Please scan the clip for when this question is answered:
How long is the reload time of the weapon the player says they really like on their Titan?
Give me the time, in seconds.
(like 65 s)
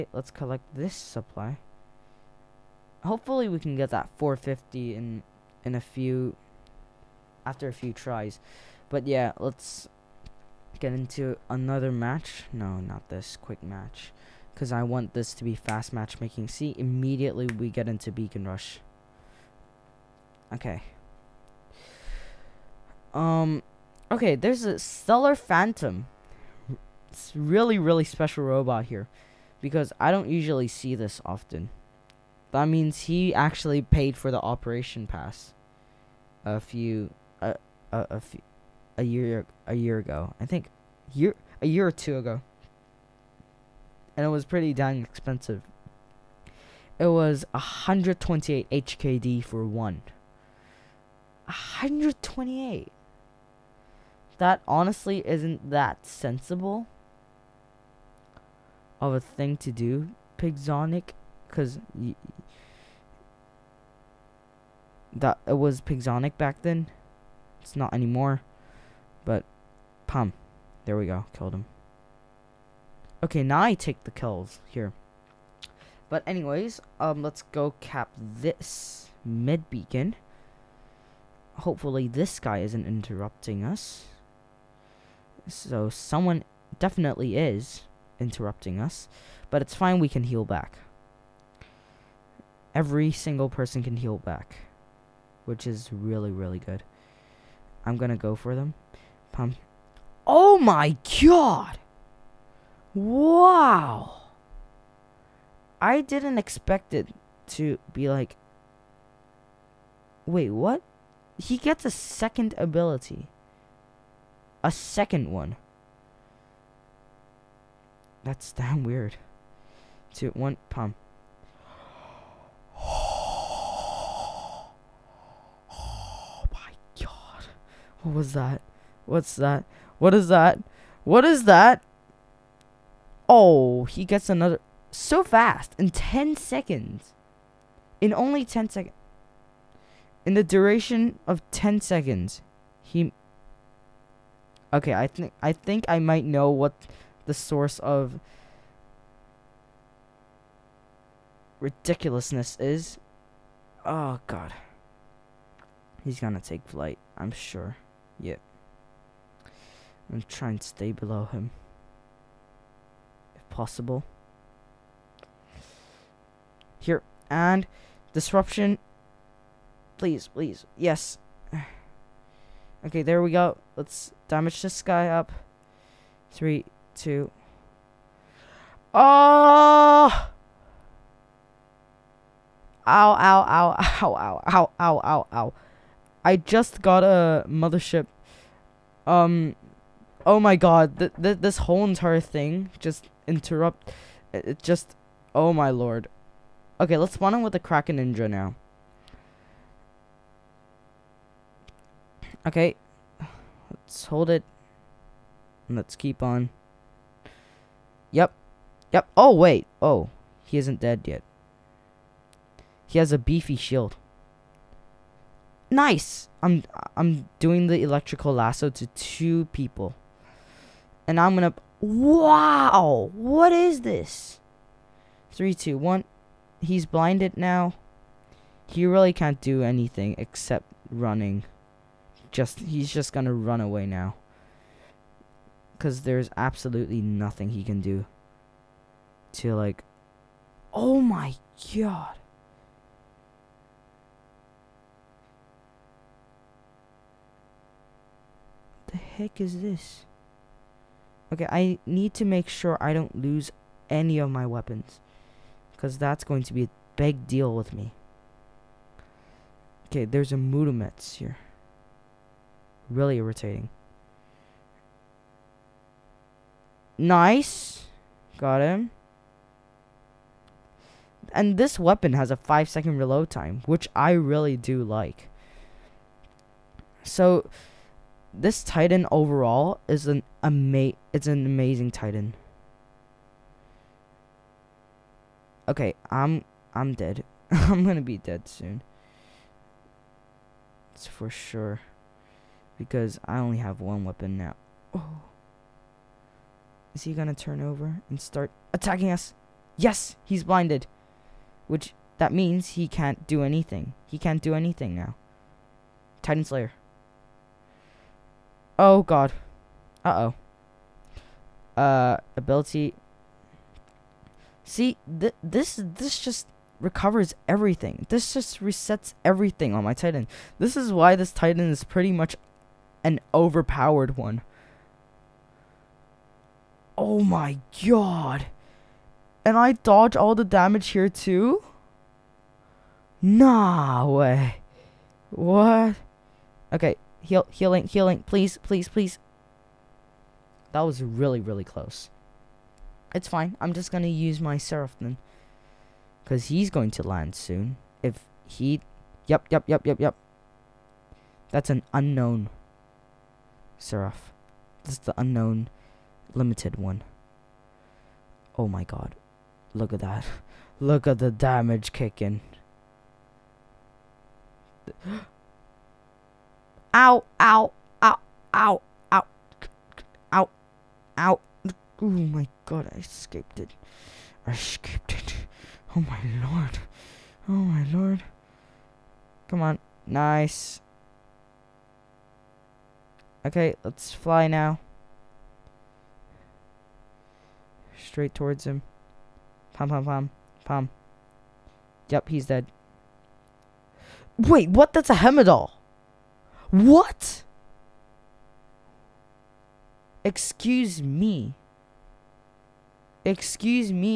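272 s.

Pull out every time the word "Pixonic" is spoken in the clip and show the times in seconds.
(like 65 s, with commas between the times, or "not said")
60 s, 65 s.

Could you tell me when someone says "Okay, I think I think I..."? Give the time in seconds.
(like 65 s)
144 s.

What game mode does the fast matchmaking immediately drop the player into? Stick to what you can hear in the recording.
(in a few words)
Beacon Rush.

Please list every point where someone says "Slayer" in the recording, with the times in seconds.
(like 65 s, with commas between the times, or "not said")
306 s.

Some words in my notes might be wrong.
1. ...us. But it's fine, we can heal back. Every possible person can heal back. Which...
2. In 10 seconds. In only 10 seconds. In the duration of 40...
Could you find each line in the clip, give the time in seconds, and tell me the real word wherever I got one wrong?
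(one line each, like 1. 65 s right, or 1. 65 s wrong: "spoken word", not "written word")
1. 88 s wrong: "single", not "possible"
2. 135 s wrong: "10", not "40".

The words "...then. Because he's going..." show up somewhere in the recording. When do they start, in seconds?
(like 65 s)
344 s.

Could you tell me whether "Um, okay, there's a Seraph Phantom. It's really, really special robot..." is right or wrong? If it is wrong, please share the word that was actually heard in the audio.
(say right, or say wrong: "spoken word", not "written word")
wrong: "Stellar", not "Seraph".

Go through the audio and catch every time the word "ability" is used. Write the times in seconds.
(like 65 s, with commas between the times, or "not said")
112 s, 312 s.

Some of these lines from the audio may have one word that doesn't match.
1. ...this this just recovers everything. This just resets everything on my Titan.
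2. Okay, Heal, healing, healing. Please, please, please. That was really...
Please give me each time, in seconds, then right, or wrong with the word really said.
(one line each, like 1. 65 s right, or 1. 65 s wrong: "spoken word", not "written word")
1. 315 s right
2. 336 s right.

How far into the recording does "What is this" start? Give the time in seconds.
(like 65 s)
223 s.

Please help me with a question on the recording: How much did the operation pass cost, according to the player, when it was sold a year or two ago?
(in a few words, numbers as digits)
128 HKD.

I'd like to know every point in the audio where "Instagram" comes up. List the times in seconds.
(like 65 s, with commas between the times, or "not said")
not said.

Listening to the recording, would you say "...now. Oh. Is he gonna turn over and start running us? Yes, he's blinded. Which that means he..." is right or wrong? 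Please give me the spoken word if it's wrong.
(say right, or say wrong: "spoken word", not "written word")
wrong: "attacking", not "running".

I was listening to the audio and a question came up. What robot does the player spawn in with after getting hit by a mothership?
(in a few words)
Kraken Ninja.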